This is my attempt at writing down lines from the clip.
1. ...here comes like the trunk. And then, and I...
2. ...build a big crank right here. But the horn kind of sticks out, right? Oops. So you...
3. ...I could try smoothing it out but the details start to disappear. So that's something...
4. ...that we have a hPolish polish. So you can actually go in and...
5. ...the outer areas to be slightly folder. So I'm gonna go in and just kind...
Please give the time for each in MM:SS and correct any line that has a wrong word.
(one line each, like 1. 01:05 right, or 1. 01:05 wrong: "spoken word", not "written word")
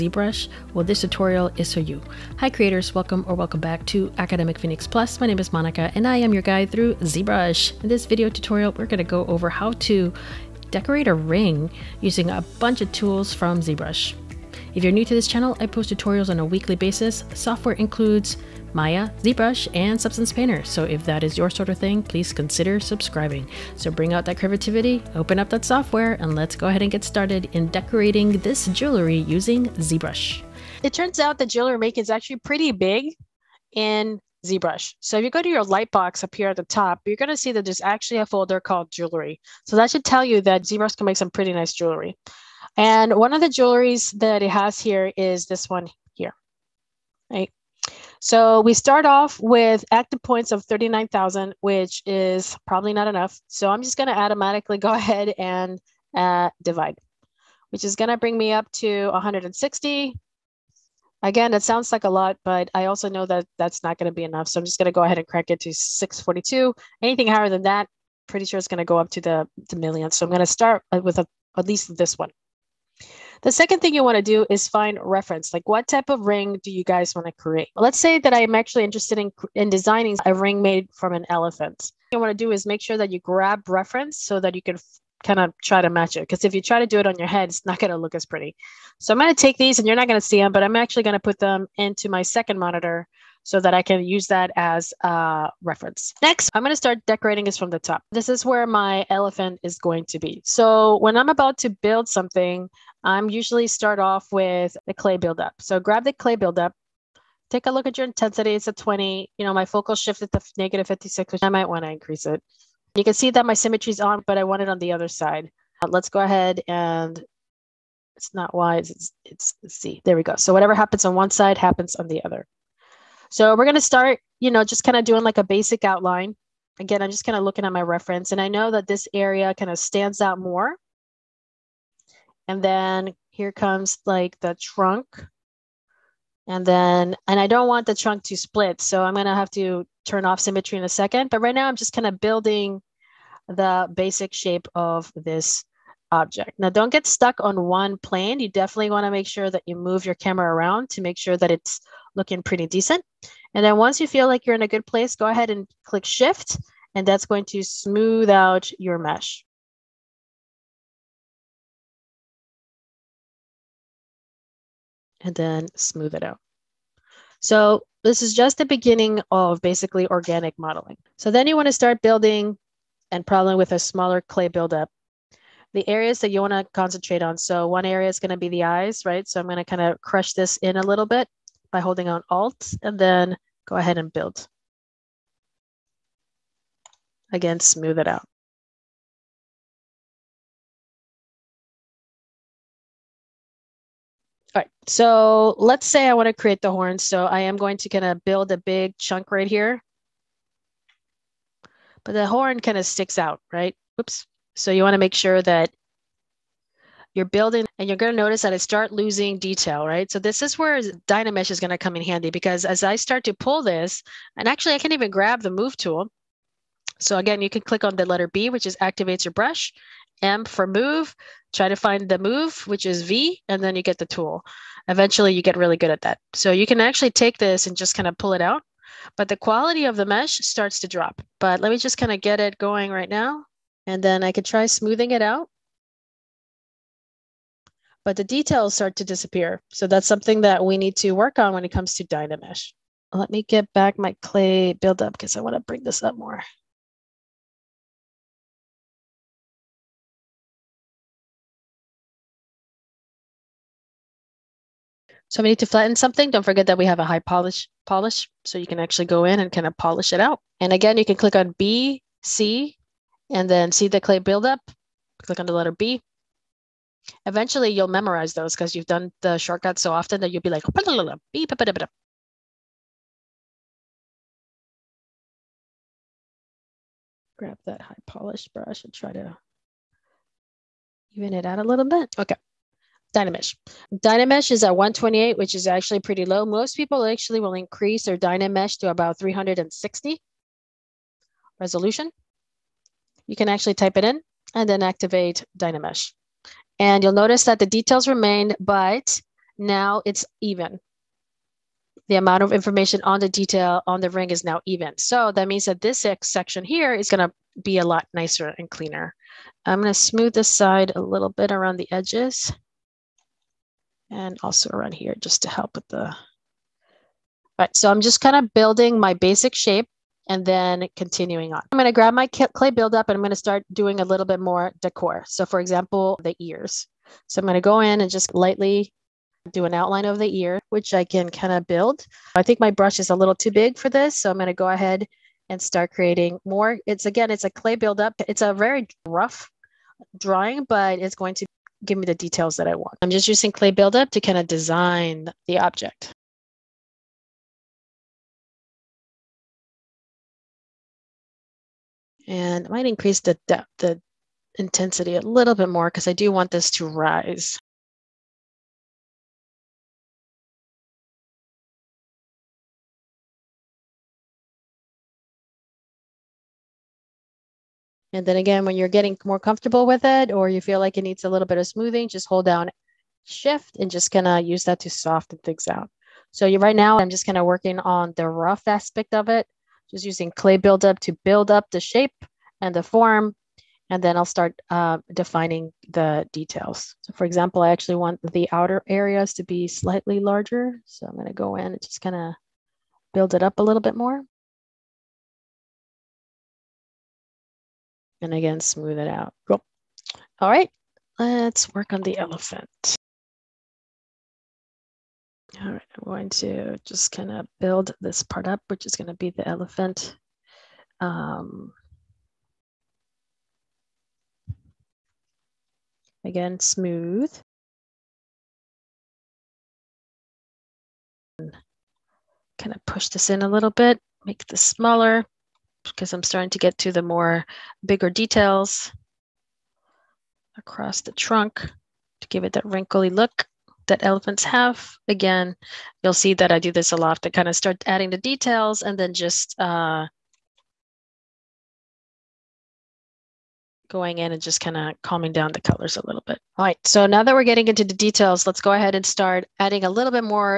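1. 02:13 right
2. 03:18 wrong: "chunk", not "crank"
3. 03:54 right
4. 04:16 right
5. 06:28 wrong: "larger", not "folder".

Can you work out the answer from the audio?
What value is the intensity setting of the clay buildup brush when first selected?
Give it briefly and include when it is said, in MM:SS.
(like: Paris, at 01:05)
20, at 01:48.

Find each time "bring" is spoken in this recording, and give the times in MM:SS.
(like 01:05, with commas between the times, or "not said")
00:23, 00:58, 04:05.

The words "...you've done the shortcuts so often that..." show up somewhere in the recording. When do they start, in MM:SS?
04:28.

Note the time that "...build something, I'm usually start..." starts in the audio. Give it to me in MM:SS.
01:41.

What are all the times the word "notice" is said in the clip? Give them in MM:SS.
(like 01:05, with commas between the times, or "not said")
03:28, 04:57.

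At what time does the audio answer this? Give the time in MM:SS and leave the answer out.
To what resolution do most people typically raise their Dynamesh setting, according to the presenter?
04:49.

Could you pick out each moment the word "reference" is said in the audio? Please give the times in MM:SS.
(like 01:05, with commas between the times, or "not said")
01:14, 01:23, 01:35, 02:07.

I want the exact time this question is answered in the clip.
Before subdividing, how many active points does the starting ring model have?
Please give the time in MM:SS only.
00:50.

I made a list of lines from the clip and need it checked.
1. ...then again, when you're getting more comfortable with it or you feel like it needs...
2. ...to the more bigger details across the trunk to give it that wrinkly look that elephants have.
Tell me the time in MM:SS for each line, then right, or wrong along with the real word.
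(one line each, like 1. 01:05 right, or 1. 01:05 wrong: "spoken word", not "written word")
1. 06:08 right
2. 07:06 right.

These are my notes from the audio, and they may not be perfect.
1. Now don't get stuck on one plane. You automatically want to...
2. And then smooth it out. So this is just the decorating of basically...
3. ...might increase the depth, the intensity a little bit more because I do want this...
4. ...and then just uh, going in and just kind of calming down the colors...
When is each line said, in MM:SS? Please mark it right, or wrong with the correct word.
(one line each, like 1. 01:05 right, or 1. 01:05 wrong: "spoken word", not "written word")
1. 02:26 wrong: "definitely", not "automatically"
2. 02:45 wrong: "beginning", not "decorating"
3. 05:52 right
4. 07:18 right.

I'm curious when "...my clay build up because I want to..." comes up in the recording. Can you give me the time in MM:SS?
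04:03.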